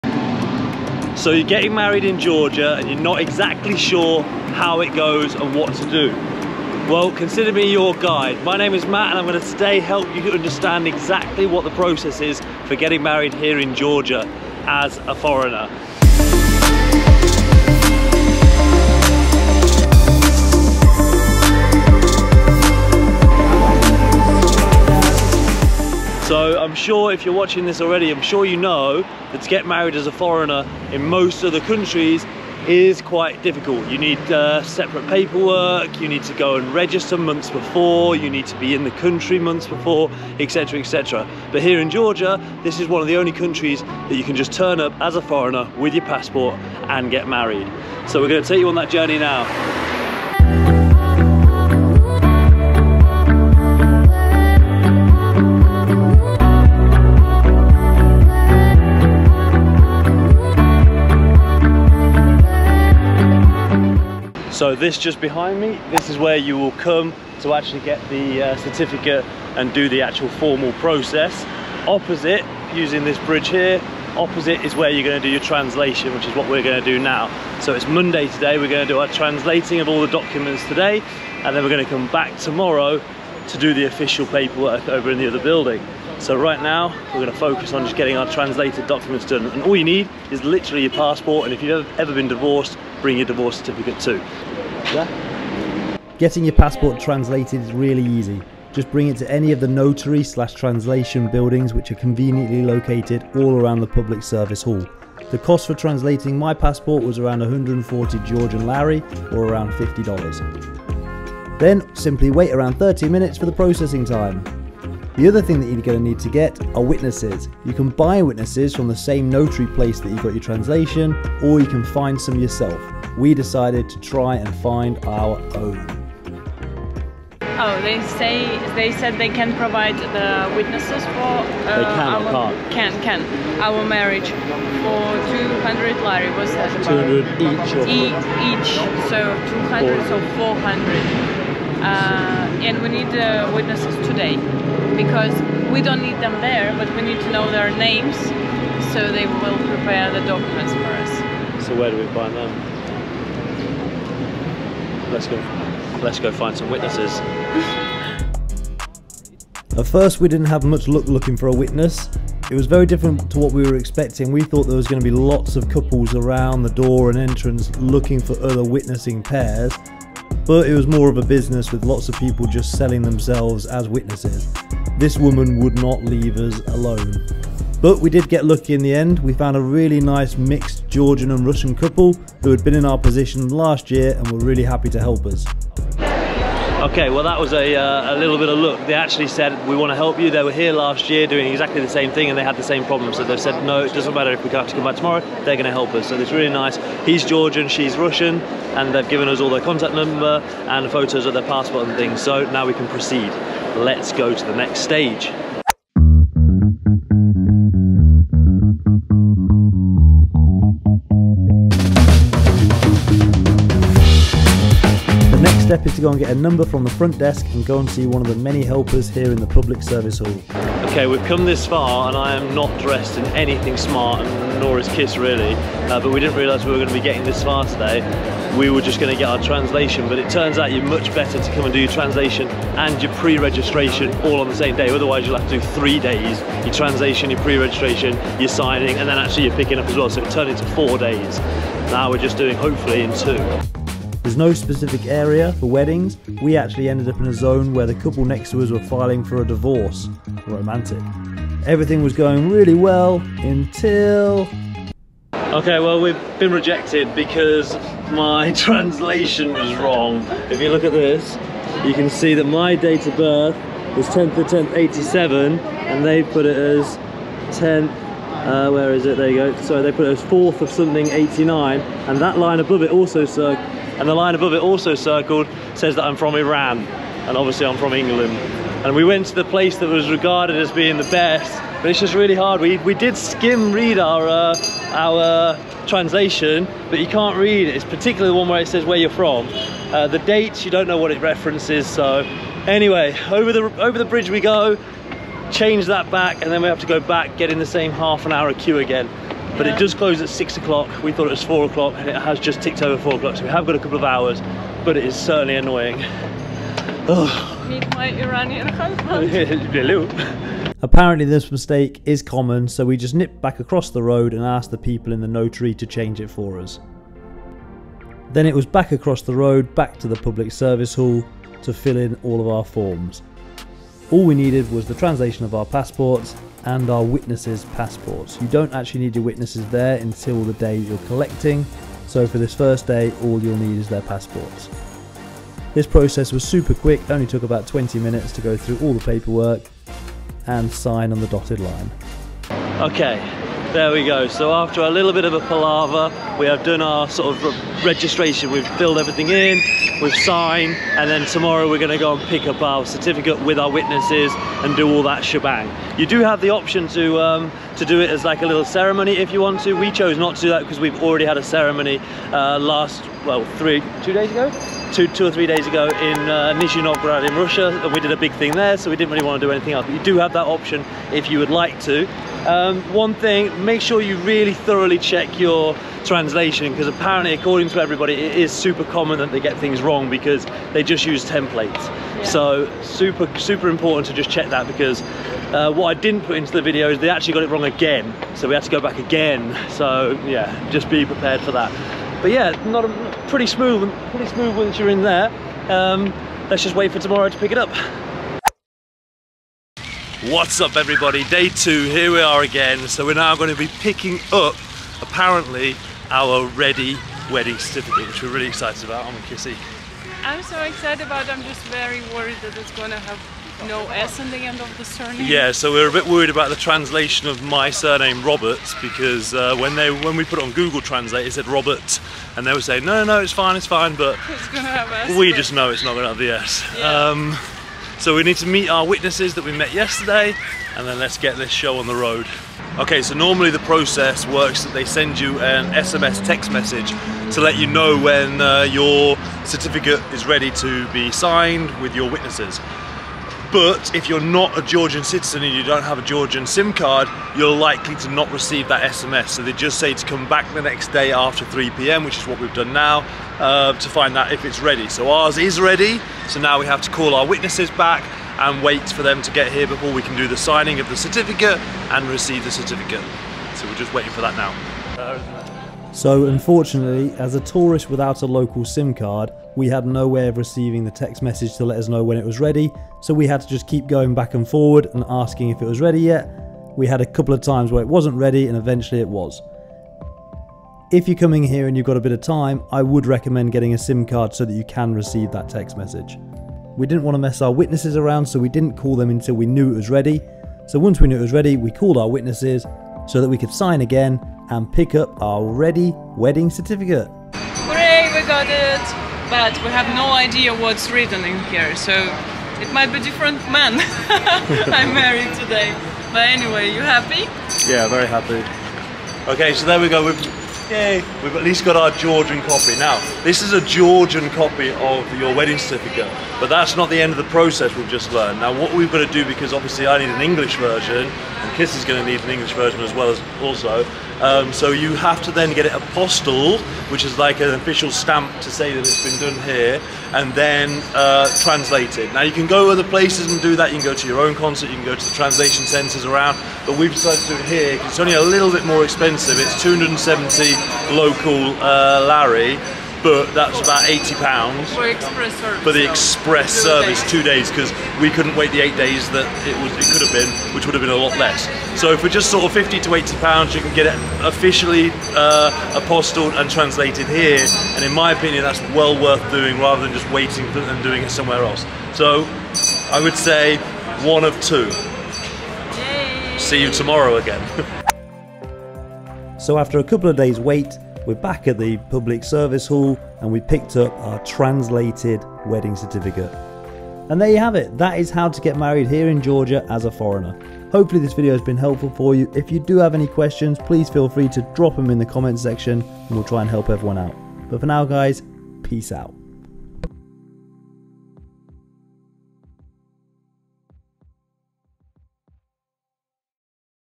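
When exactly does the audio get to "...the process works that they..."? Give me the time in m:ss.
7:13.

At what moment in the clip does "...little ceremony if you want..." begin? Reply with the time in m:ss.
5:58.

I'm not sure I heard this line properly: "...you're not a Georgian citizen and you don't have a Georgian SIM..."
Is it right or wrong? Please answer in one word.
right.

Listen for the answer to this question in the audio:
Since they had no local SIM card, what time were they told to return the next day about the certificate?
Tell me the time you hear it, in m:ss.
7:31.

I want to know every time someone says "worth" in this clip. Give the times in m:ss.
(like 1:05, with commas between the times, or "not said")
9:19.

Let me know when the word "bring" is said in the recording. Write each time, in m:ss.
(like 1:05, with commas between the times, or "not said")
1:33, 1:38.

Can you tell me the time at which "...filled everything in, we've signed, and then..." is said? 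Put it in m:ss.
5:48.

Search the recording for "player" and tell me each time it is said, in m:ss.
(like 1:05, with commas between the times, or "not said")
not said.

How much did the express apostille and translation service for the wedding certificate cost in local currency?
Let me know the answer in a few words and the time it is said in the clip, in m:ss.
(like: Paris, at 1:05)
270 lari, at 8:59.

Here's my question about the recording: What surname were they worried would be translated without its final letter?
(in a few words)
Roberts.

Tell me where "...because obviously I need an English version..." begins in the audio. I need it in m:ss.
8:39.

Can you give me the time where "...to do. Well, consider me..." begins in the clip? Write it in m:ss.
0:05.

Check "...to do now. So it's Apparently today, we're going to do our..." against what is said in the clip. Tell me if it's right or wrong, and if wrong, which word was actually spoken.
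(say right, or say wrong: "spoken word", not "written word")
wrong: "Monday", not "Apparently".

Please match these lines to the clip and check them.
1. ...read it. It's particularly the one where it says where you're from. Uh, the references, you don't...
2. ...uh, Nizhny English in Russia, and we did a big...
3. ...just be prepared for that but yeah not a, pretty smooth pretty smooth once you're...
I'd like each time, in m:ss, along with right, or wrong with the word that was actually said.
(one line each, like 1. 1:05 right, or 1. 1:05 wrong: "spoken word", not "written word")
1. 4:47 wrong: "dates", not "references"
2. 6:06 wrong: "Novgorod", not "English"
3. 6:30 right.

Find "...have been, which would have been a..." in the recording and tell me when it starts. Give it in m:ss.
9:10.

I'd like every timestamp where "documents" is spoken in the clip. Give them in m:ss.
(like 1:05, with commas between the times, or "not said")
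1:20, 1:28, 2:30.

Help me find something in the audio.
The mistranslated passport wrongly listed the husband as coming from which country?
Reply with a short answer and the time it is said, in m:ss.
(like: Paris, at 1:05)
Iran, at 4:36.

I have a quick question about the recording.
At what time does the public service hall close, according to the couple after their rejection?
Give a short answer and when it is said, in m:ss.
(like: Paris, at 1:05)
6 o'clock, at 5:00.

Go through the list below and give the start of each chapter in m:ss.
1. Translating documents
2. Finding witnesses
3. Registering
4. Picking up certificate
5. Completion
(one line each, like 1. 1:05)
1. 1:34
2. 2:35
3. 3:42
4. 6:38
5. 8:35.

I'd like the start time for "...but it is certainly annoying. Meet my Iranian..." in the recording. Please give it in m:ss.
5:04.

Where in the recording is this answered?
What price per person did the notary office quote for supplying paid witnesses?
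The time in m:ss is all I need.
2:14.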